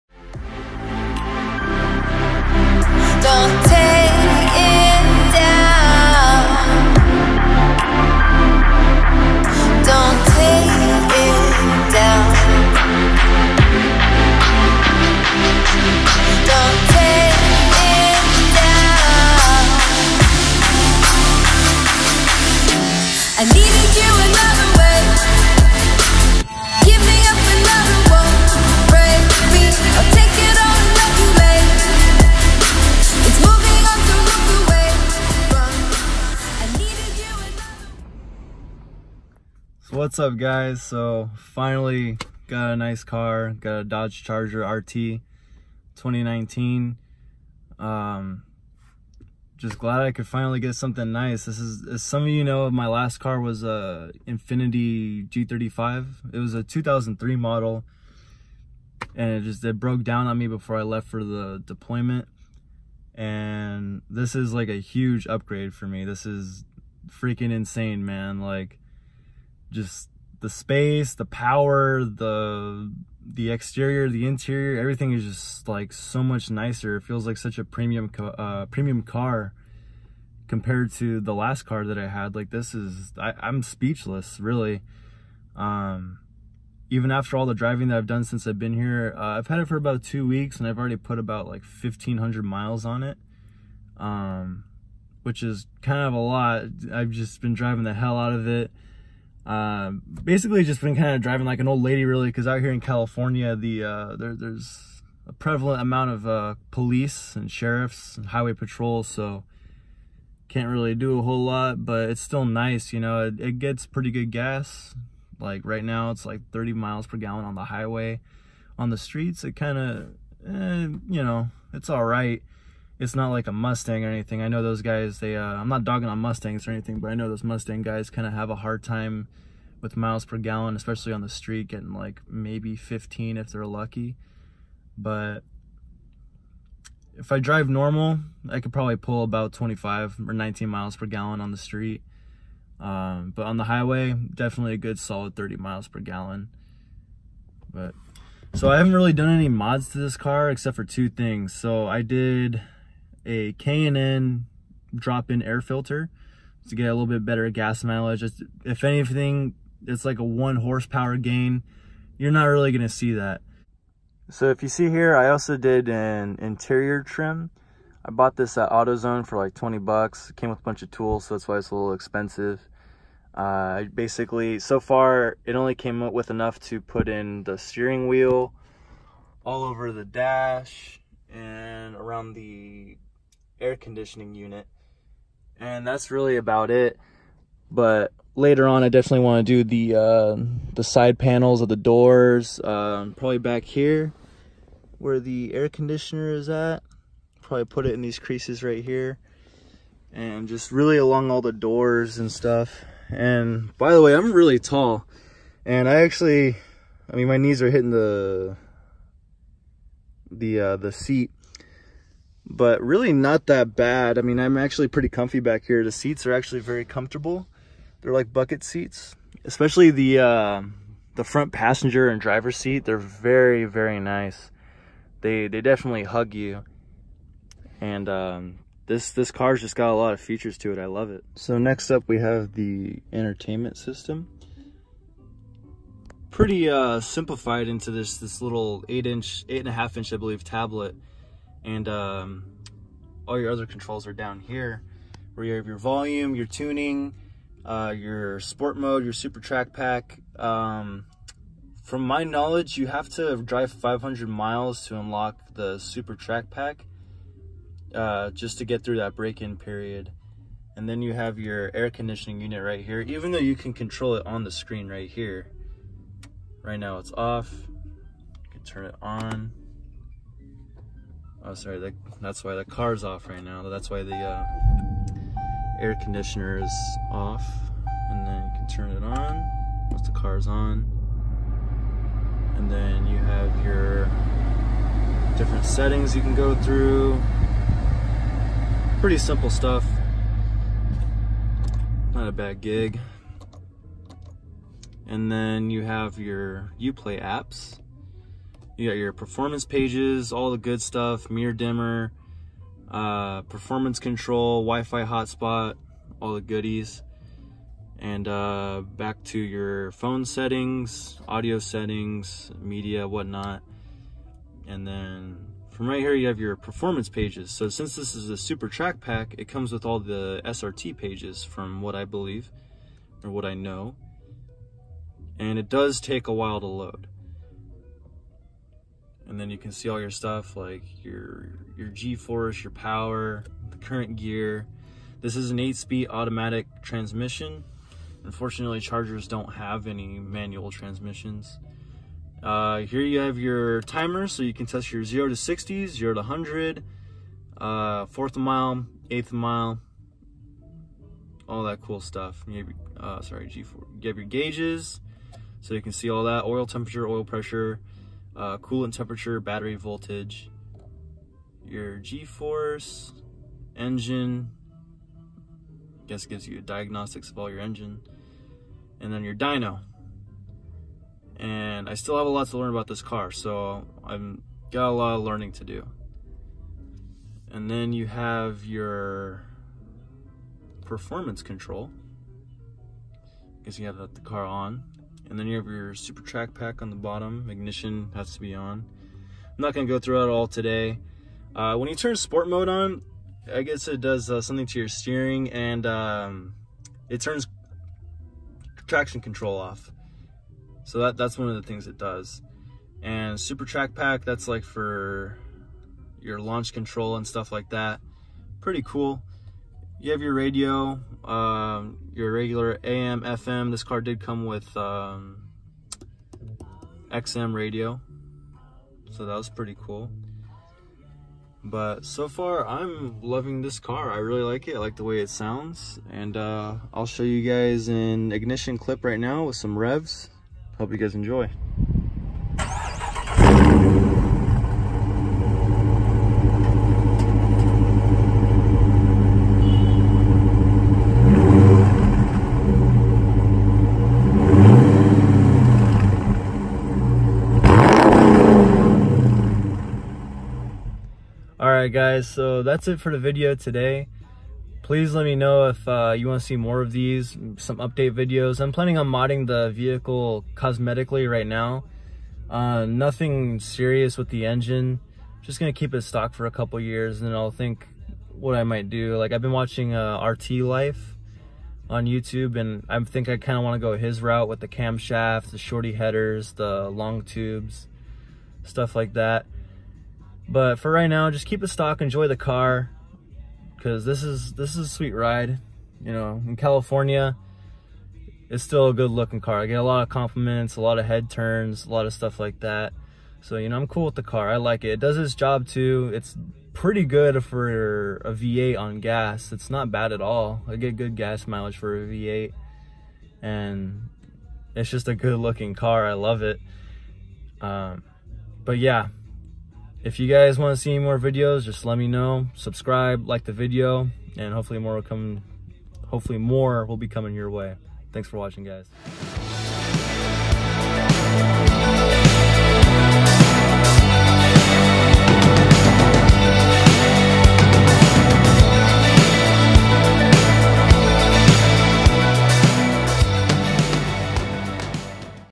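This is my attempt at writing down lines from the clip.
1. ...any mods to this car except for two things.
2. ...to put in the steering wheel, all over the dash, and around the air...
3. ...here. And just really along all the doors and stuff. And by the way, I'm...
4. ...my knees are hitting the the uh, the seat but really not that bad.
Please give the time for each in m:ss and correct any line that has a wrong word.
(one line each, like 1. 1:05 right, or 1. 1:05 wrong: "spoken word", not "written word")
1. 2:29 right
2. 2:56 right
3. 3:18 right
4. 3:27 right.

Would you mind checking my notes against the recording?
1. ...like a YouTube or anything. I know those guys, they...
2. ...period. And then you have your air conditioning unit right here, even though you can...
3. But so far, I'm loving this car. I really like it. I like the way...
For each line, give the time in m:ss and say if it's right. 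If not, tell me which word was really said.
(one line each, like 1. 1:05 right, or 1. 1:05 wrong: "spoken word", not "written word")
1. 2:03 wrong: "Mustang", not "YouTube"
2. 4:19 right
3. 7:01 right.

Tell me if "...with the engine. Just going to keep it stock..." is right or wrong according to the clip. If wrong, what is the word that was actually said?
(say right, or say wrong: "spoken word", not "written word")
right.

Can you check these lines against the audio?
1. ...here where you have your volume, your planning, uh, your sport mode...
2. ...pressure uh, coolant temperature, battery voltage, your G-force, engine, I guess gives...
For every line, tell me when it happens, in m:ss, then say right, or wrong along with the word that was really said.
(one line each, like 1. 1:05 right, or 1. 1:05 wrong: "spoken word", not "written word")
1. 4:04 wrong: "tuning", not "planning"
2. 5:57 right.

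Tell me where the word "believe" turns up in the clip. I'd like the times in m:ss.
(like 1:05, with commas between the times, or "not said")
4:00, 5:22.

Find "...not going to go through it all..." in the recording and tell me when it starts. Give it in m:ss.
6:29.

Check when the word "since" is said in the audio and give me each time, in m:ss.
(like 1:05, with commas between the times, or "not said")
1:28, 5:17.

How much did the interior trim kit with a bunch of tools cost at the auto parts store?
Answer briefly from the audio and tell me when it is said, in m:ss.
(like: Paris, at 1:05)
20 bucks, at 2:49.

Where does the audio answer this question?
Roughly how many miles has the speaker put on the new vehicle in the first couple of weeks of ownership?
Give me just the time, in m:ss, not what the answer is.
1:31.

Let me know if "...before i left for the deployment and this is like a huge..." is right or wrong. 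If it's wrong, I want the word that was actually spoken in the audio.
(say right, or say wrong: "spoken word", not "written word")
right.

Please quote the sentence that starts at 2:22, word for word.
Um, but on the highway, definitely a good solid 30 miles per gallon.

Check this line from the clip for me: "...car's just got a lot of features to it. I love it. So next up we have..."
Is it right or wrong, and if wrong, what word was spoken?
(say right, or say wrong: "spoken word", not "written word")
right.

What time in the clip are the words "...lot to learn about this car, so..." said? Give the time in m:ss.
6:12.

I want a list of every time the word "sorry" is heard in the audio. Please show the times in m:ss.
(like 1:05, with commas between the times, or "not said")
4:31, 5:53.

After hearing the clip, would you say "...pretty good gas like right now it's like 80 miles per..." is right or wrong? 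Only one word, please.
wrong.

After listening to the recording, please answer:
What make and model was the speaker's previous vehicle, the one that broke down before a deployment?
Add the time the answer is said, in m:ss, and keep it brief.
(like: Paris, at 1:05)
Infiniti G35, at 0:54.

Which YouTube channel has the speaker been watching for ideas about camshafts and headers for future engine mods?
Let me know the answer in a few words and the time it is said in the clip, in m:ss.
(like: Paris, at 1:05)
RT Life, at 7:50.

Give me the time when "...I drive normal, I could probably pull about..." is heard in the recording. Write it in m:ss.
2:17.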